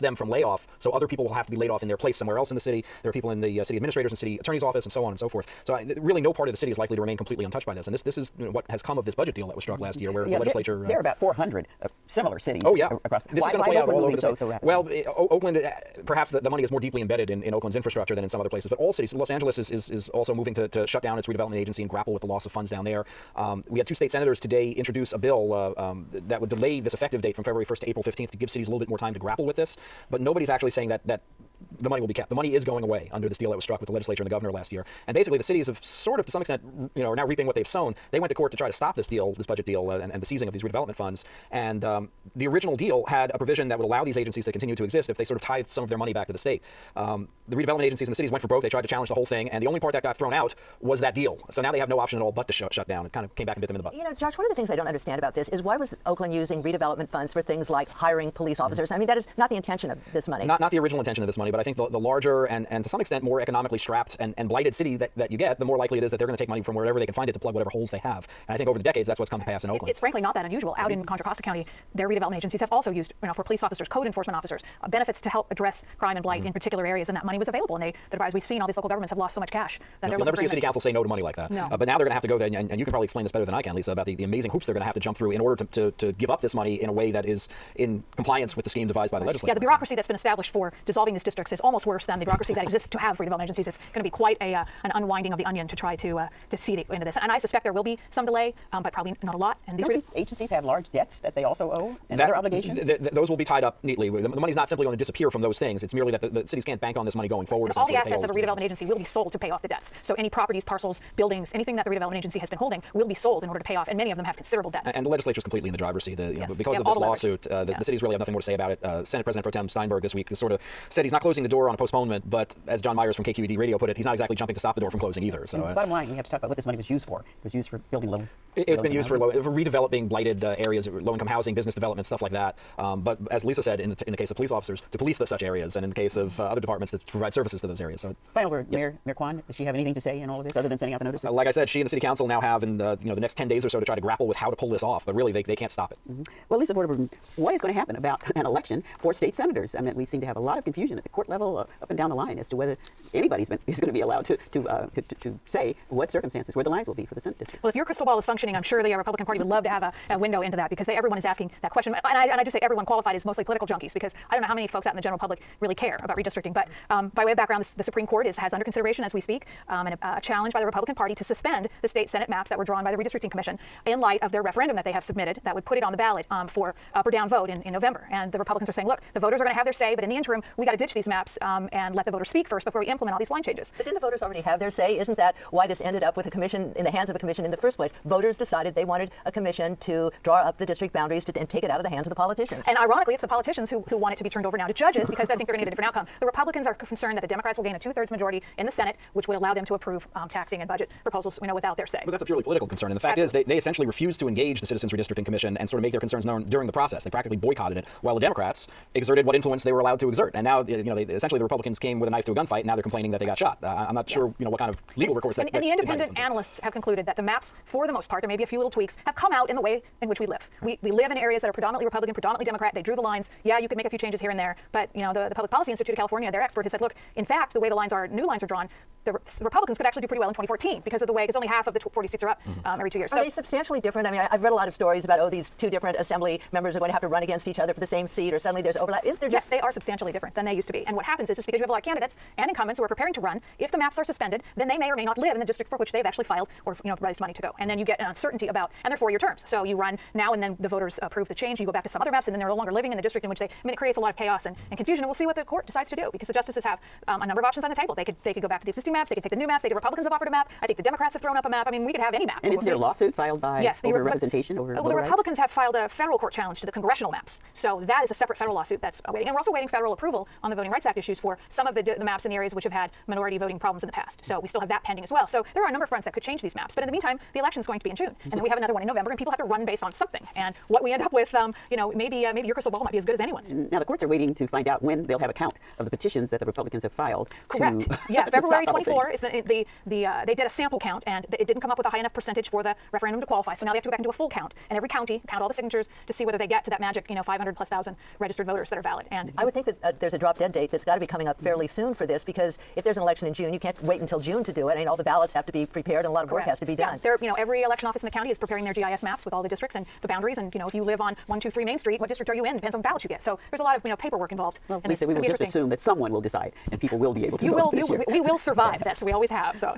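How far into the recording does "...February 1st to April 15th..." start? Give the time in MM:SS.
00:27.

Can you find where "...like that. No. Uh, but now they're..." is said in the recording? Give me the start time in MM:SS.
01:21.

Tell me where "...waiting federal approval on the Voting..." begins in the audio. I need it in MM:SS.
04:29.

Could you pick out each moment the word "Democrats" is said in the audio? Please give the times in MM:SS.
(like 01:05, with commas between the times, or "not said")
03:17, 03:28, 03:42, 04:20.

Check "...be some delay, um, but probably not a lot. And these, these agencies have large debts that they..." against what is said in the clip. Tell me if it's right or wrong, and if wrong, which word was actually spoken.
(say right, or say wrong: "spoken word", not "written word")
right.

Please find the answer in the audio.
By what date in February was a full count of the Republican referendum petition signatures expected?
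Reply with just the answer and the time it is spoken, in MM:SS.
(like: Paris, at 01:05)
February 24, at 04:48.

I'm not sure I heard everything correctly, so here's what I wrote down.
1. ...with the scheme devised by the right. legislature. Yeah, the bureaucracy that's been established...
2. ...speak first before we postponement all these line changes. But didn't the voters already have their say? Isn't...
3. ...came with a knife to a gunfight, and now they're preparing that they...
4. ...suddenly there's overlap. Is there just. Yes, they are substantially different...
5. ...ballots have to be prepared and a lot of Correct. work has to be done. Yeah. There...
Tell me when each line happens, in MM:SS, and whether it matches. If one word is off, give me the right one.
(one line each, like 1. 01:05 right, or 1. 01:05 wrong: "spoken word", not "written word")
1. 01:28 right
2. 03:02 wrong: "implement", not "postponement"
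3. 03:31 wrong: "complaining", not "preparing"
4. 03:58 right
5. 05:05 right.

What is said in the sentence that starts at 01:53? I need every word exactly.
And many of them have considerable debt.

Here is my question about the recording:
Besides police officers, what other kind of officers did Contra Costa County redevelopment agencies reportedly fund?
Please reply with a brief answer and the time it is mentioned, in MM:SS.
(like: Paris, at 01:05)
Code enforcement officers, at 01:13.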